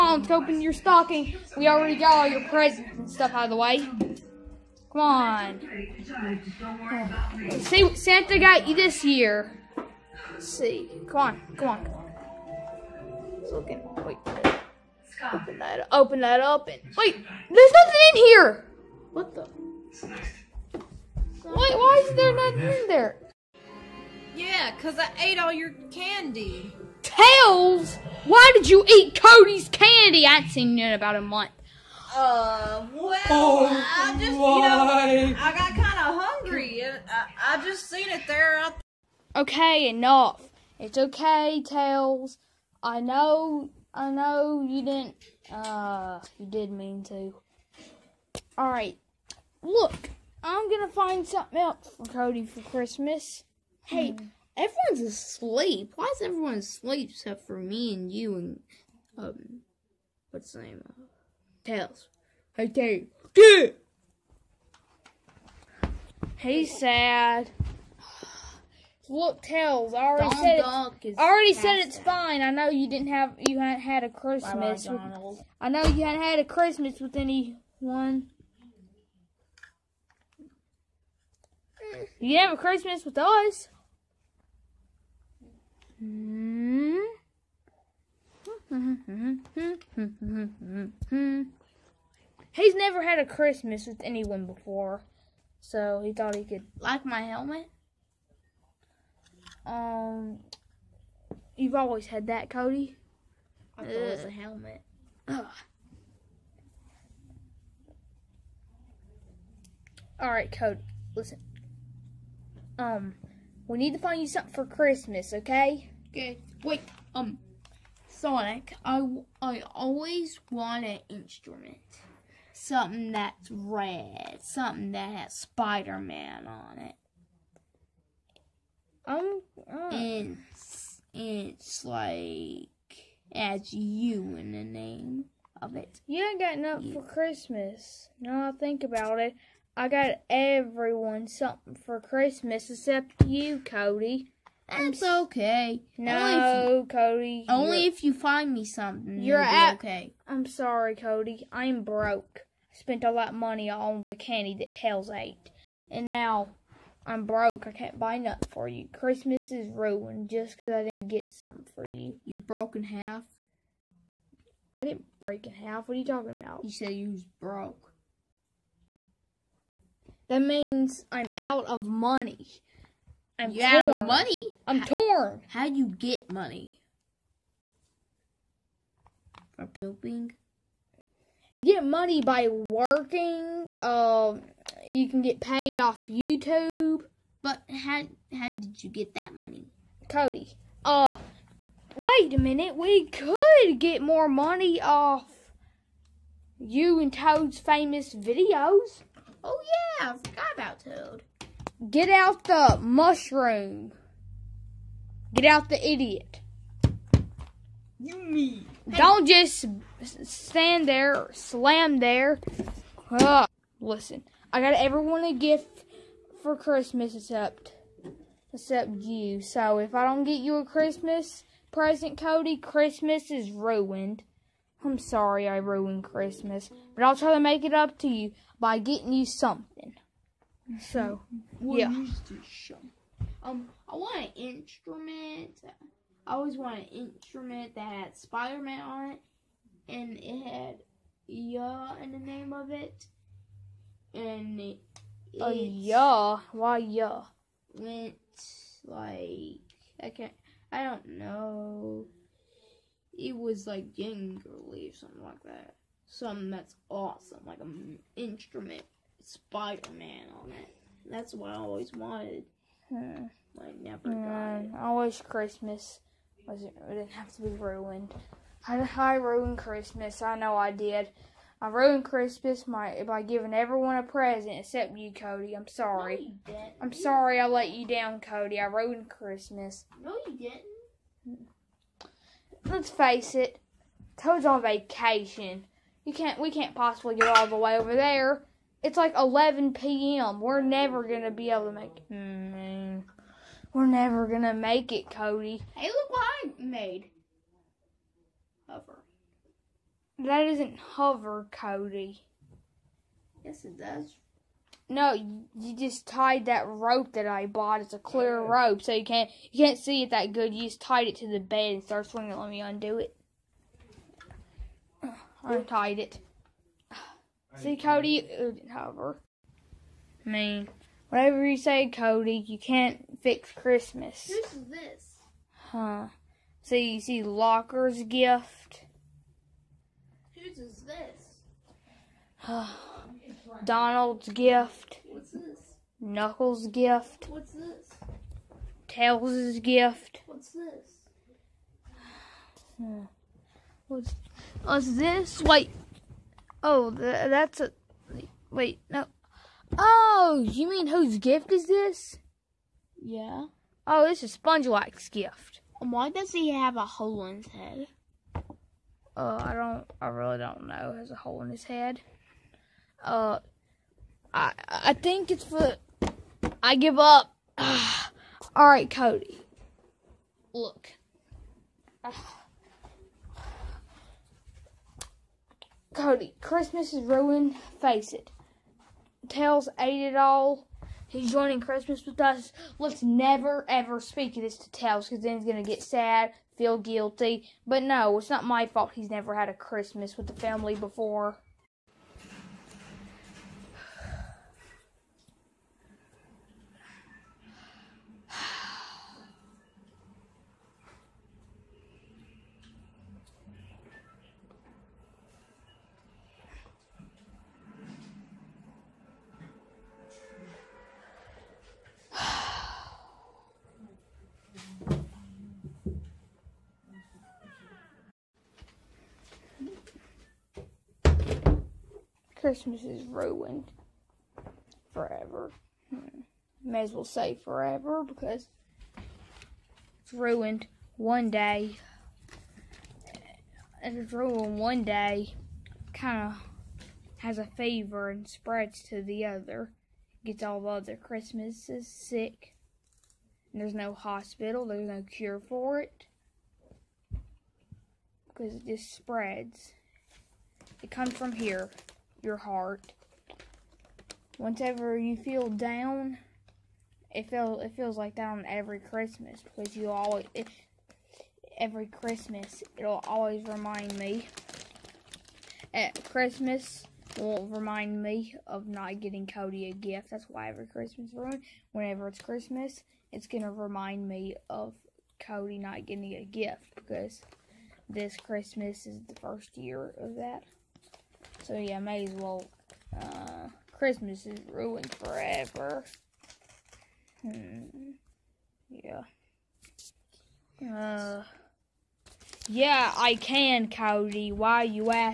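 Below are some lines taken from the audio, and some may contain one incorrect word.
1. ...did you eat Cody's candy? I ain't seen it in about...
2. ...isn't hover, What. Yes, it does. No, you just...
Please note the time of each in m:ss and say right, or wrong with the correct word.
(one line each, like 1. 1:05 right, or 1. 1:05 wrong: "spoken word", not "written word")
1. 0:28 right
2. 5:00 wrong: "Cody", not "What".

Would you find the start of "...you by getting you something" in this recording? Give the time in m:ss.
3:48.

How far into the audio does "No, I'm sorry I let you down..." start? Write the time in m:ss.
4:36.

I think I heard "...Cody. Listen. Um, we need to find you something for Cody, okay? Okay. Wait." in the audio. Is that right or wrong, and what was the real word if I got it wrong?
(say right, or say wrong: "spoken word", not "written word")
wrong: "Christmas", not "Cody".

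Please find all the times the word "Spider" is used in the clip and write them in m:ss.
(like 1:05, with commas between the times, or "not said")
2:05, 3:58, 4:19.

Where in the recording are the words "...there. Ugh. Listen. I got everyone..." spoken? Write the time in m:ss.
3:31.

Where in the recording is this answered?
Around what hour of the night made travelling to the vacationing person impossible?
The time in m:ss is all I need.
4:49.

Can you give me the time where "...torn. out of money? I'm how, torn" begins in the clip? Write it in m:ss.
2:53.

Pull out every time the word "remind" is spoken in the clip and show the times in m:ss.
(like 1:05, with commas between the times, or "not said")
7:43, 7:47, 7:53.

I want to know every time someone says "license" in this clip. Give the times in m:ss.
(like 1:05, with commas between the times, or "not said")
not said.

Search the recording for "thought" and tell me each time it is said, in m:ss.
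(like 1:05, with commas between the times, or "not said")
1:36, 1:43.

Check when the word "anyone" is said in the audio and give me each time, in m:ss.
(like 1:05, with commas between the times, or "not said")
1:17, 1:34.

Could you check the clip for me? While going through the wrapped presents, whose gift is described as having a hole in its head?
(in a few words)
SpongeBob.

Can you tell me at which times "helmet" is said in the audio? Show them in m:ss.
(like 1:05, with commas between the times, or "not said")
1:37, 1:44.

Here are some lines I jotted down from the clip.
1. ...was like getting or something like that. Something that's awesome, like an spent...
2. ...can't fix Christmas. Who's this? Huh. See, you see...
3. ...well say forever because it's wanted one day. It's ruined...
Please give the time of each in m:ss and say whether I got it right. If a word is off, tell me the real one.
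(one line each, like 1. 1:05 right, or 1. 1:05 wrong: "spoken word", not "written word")
1. 4:13 wrong: "instrument", not "spent"
2. 5:22 right
3. 7:06 wrong: "ruined", not "wanted".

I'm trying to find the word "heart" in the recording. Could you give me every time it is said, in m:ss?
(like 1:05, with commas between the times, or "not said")
7:32.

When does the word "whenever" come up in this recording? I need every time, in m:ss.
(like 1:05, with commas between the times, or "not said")
7:34, 7:51.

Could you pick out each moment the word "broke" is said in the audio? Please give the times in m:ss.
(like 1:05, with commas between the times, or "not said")
2:31, 2:37, 2:42, 2:47.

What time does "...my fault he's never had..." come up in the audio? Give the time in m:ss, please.
6:28.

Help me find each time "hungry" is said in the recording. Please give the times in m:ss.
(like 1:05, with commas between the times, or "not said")
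0:36.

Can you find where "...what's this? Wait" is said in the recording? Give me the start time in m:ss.
5:44.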